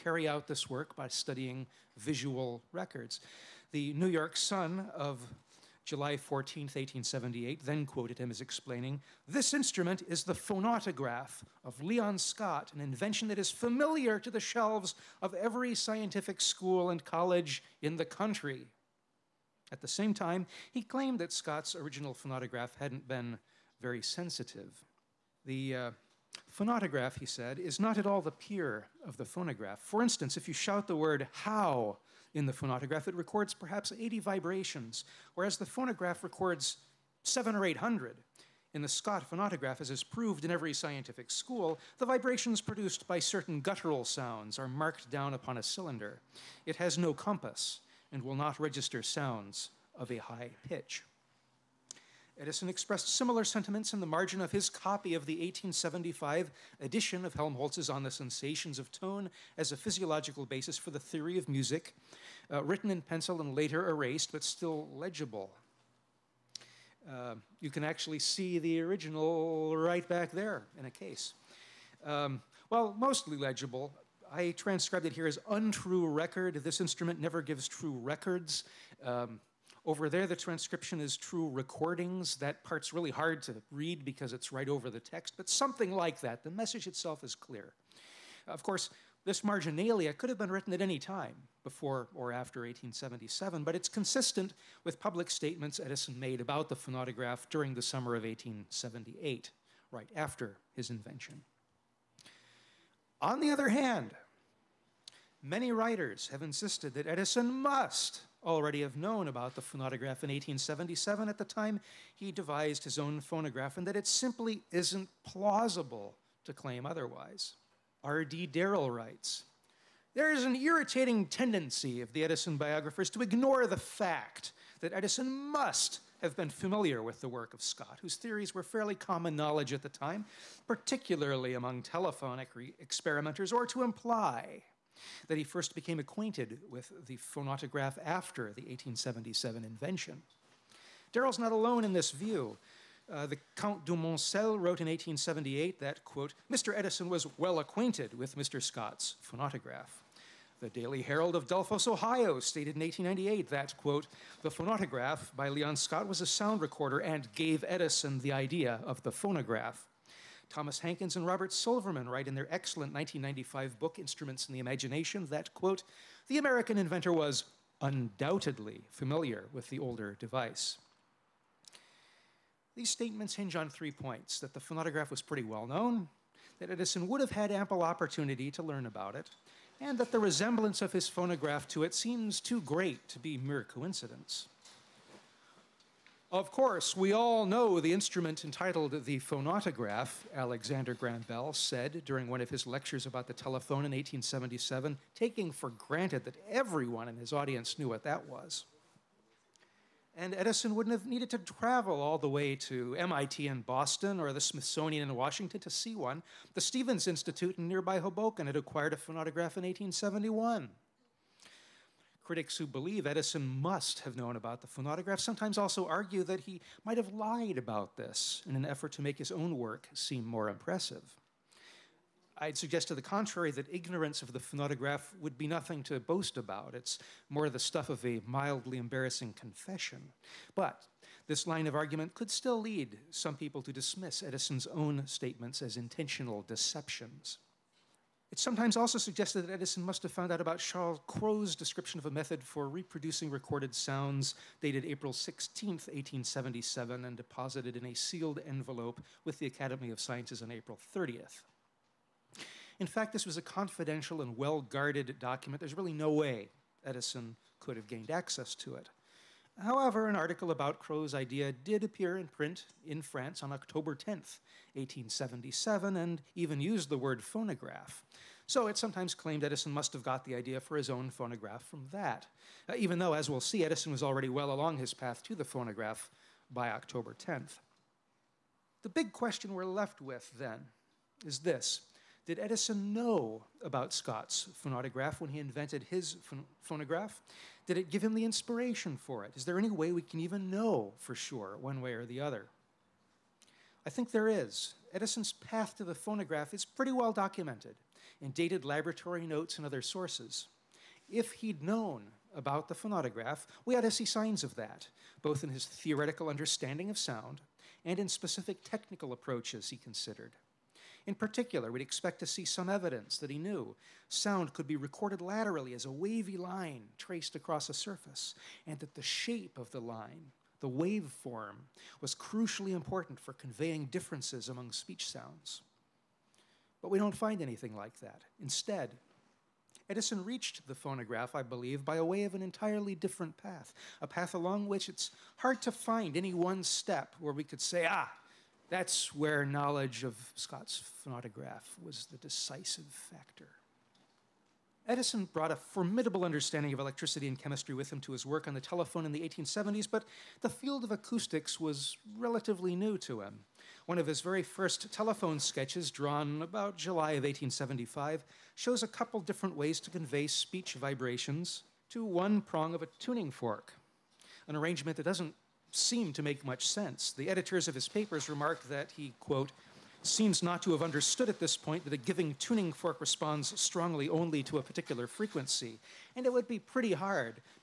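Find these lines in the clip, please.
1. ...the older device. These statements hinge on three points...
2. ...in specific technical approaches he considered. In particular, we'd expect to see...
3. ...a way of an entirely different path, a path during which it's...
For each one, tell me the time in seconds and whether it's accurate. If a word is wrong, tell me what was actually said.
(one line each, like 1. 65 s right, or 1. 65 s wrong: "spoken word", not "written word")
1. 169 s right
2. 307 s right
3. 331 s wrong: "along", not "during".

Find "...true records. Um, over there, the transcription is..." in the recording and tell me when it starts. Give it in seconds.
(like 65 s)
77 s.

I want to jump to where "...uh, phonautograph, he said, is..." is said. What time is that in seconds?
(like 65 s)
25 s.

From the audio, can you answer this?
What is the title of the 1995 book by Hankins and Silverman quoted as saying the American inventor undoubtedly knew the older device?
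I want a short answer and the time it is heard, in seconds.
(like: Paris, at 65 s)
Instruments in the Imagination, at 163 s.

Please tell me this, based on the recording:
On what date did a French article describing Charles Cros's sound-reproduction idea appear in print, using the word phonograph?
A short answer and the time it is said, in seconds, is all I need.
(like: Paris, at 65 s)
October 10th, 1877, at 263 s.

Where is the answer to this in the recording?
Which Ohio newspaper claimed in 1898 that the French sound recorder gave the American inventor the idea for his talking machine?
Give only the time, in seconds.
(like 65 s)
150 s.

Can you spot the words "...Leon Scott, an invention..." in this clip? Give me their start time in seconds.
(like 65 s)
11 s.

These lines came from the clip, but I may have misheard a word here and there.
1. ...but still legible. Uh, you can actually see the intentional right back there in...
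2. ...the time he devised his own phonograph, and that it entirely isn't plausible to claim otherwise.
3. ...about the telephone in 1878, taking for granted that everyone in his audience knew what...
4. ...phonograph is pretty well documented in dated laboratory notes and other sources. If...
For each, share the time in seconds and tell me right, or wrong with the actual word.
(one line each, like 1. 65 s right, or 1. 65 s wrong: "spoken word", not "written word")
1. 64 s wrong: "original", not "intentional"
2. 111 s wrong: "simply", not "entirely"
3. 193 s wrong: "1877", not "1878"
4. 295 s right.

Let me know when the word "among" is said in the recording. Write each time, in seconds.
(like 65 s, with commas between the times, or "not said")
131 s, 324 s.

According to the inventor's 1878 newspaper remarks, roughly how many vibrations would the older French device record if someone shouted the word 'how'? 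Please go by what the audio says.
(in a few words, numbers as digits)
80.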